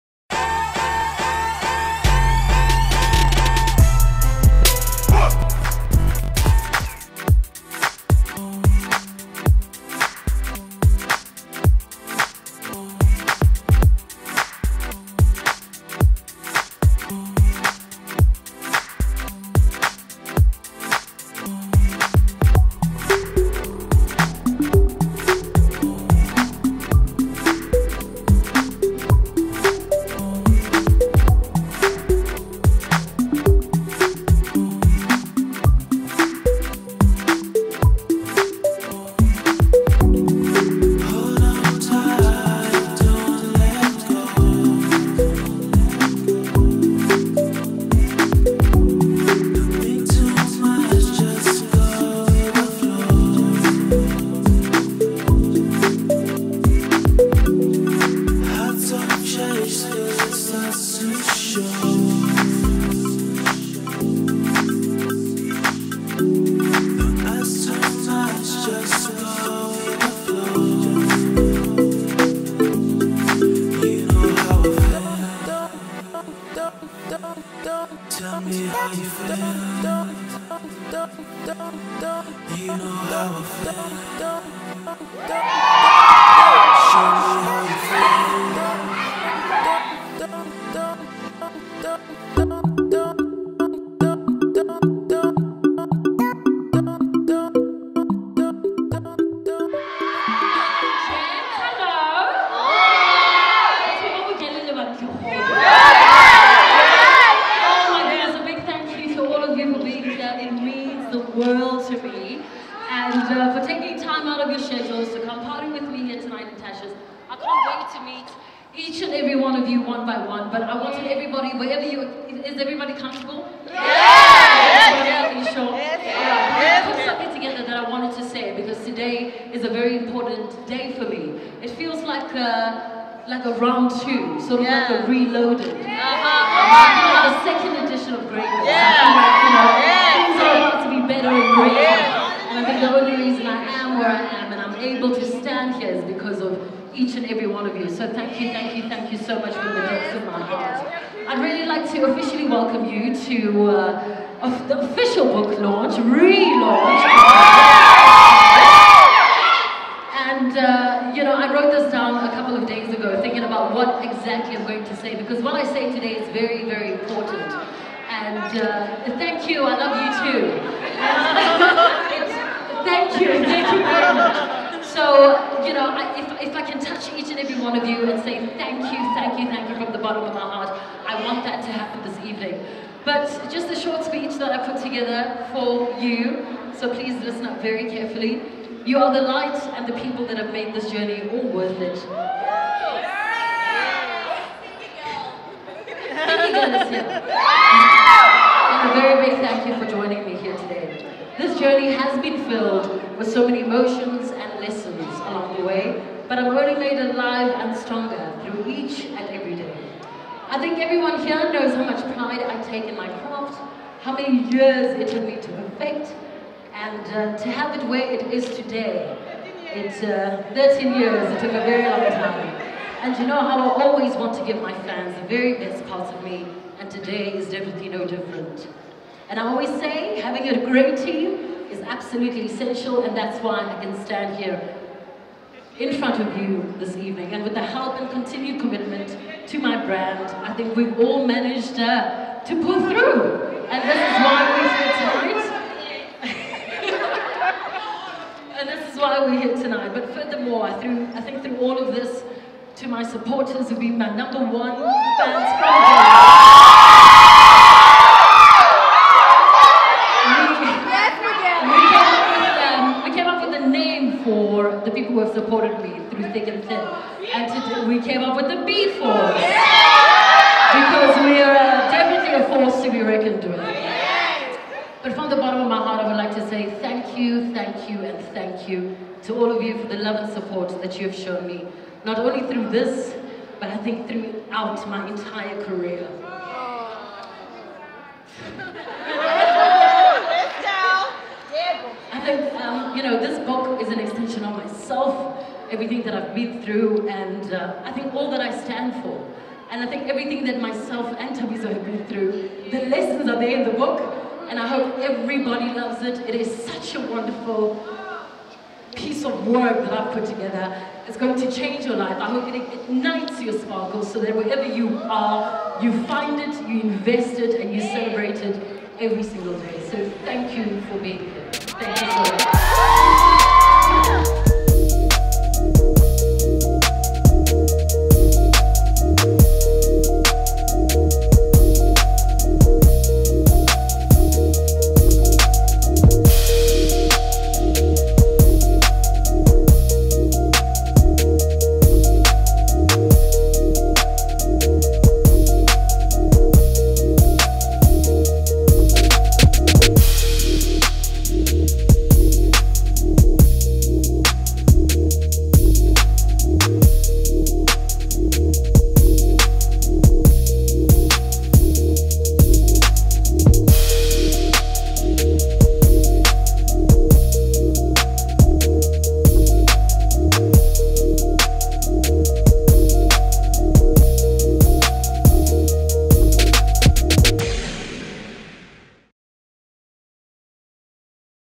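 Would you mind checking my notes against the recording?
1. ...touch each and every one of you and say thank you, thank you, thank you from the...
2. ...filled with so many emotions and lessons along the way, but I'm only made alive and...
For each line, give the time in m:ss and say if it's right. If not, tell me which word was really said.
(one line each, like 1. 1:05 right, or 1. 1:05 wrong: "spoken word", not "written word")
1. 2:56 right
2. 3:22 right.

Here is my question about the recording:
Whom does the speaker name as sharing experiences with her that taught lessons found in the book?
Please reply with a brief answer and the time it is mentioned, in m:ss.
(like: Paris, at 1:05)
Tabiza, at 5:01.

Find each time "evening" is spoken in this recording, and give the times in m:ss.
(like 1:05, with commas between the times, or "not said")
3:02, 3:56.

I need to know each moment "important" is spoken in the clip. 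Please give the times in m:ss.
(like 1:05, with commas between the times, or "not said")
2:09, 2:46.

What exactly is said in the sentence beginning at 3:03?
But just a short speech that I put together for you, so please listen up very carefully.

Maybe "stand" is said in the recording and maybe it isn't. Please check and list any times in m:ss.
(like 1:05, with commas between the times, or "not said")
2:25, 3:54, 4:58.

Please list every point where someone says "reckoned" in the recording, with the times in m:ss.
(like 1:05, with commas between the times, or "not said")
4:33.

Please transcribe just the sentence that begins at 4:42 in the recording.
Not only through this, but I think throughout my entire career.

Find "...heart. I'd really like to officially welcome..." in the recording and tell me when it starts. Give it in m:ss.
2:30.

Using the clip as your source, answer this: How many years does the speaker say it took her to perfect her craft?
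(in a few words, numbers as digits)
13.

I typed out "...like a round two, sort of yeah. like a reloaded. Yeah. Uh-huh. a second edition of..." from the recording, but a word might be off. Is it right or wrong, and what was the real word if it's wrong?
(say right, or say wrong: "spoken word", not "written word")
right.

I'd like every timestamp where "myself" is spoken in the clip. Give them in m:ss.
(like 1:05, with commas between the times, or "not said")
5:00.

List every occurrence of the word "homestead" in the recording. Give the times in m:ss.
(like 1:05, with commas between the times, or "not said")
not said.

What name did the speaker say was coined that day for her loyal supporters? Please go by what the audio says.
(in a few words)
B Force.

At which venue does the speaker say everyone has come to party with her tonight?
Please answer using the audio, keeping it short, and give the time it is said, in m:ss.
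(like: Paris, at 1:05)
Tasha's, at 1:56.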